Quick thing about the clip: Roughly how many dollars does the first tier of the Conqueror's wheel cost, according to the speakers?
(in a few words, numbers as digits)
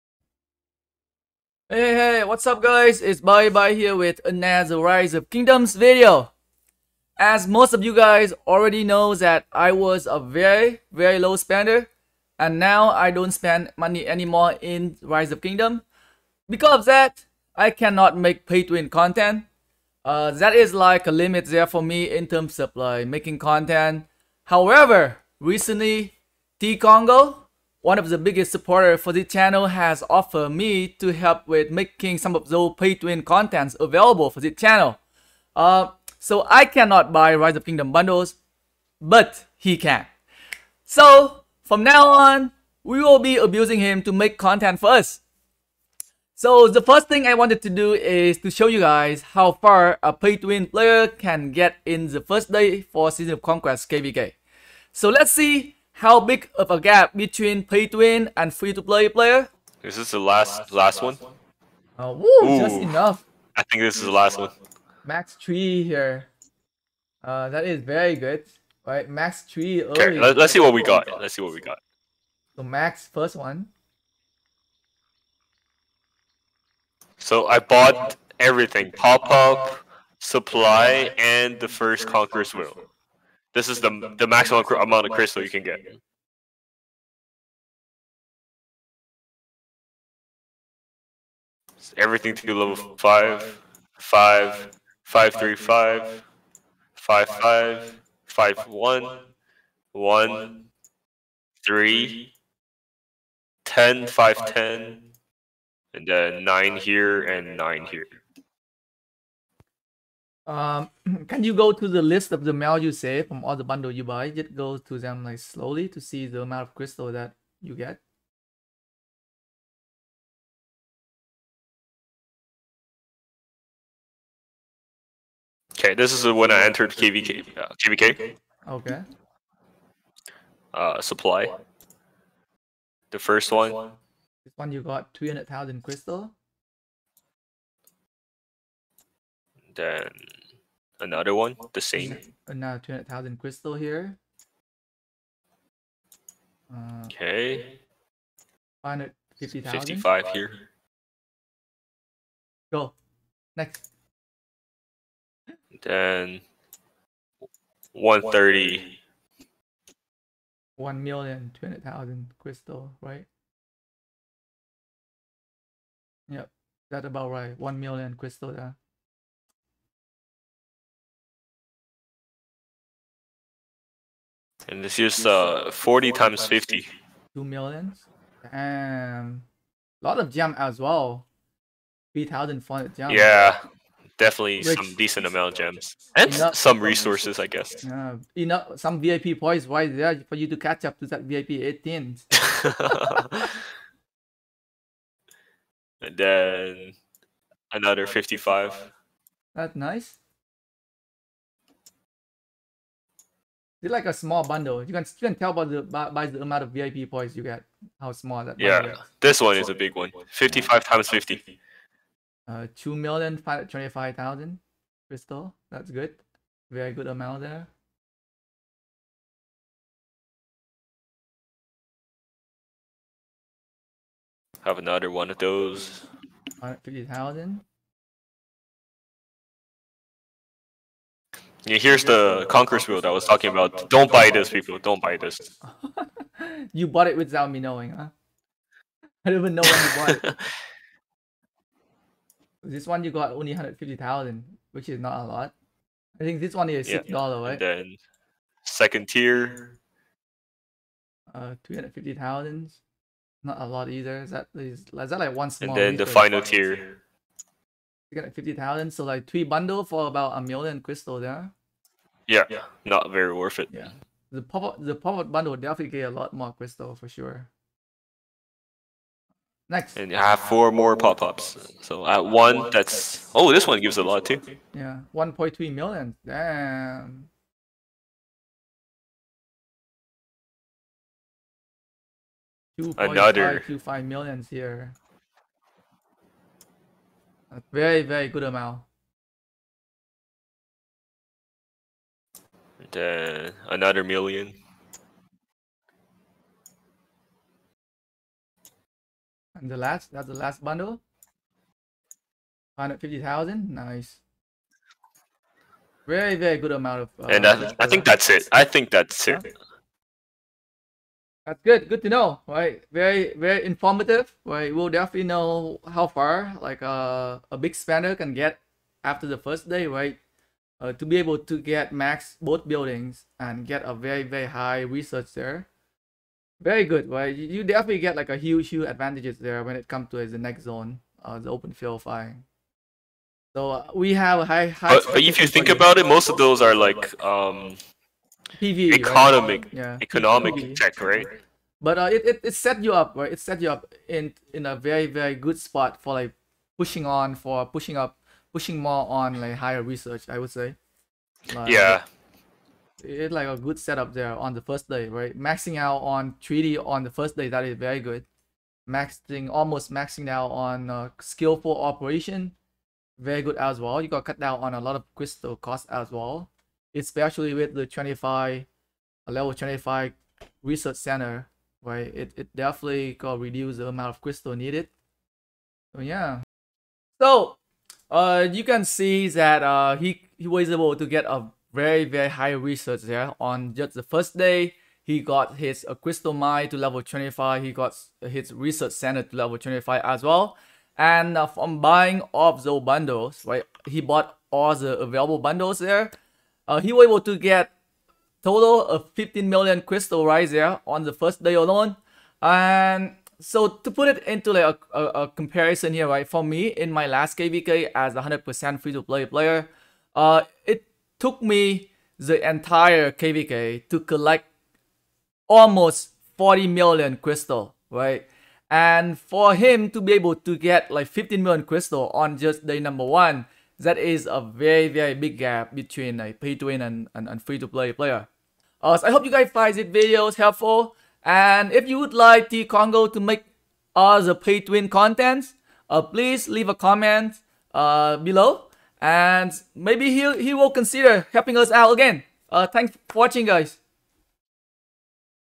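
$6.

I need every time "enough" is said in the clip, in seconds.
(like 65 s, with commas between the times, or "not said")
62 s, 186 s.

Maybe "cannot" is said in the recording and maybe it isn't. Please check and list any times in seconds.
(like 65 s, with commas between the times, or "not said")
17 s, 36 s.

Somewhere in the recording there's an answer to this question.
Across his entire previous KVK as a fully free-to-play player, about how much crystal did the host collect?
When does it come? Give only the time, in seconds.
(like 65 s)
416 s.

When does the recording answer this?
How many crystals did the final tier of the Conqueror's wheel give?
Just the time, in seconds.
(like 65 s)
258 s.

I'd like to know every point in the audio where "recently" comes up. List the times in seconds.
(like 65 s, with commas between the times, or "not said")
25 s.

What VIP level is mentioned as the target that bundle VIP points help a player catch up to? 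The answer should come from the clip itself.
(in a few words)
VIP 18.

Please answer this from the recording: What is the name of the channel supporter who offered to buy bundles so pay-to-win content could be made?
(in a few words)
T-Congo.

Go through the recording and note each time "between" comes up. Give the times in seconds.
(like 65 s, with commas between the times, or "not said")
57 s, 425 s.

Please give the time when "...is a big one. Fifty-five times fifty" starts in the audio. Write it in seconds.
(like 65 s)
209 s.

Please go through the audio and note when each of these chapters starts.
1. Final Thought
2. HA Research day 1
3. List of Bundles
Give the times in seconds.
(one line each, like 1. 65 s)
1. 320 s
2. 60 s
3. 120 s.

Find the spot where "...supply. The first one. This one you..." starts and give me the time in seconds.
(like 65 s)
131 s.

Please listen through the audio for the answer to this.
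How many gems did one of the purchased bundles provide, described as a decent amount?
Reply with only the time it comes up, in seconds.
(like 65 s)
182 s.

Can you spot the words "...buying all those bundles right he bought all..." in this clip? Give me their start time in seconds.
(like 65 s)
391 s.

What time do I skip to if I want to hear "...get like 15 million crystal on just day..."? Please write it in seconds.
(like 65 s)
420 s.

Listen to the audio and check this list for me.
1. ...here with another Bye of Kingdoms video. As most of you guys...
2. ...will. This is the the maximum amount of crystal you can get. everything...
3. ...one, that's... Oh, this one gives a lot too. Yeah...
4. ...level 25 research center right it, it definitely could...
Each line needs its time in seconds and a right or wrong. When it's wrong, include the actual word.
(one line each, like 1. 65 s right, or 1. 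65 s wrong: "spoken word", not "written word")
1. 3 s wrong: "Rise", not "Bye"
2. 82 s right
3. 272 s right
4. 369 s right.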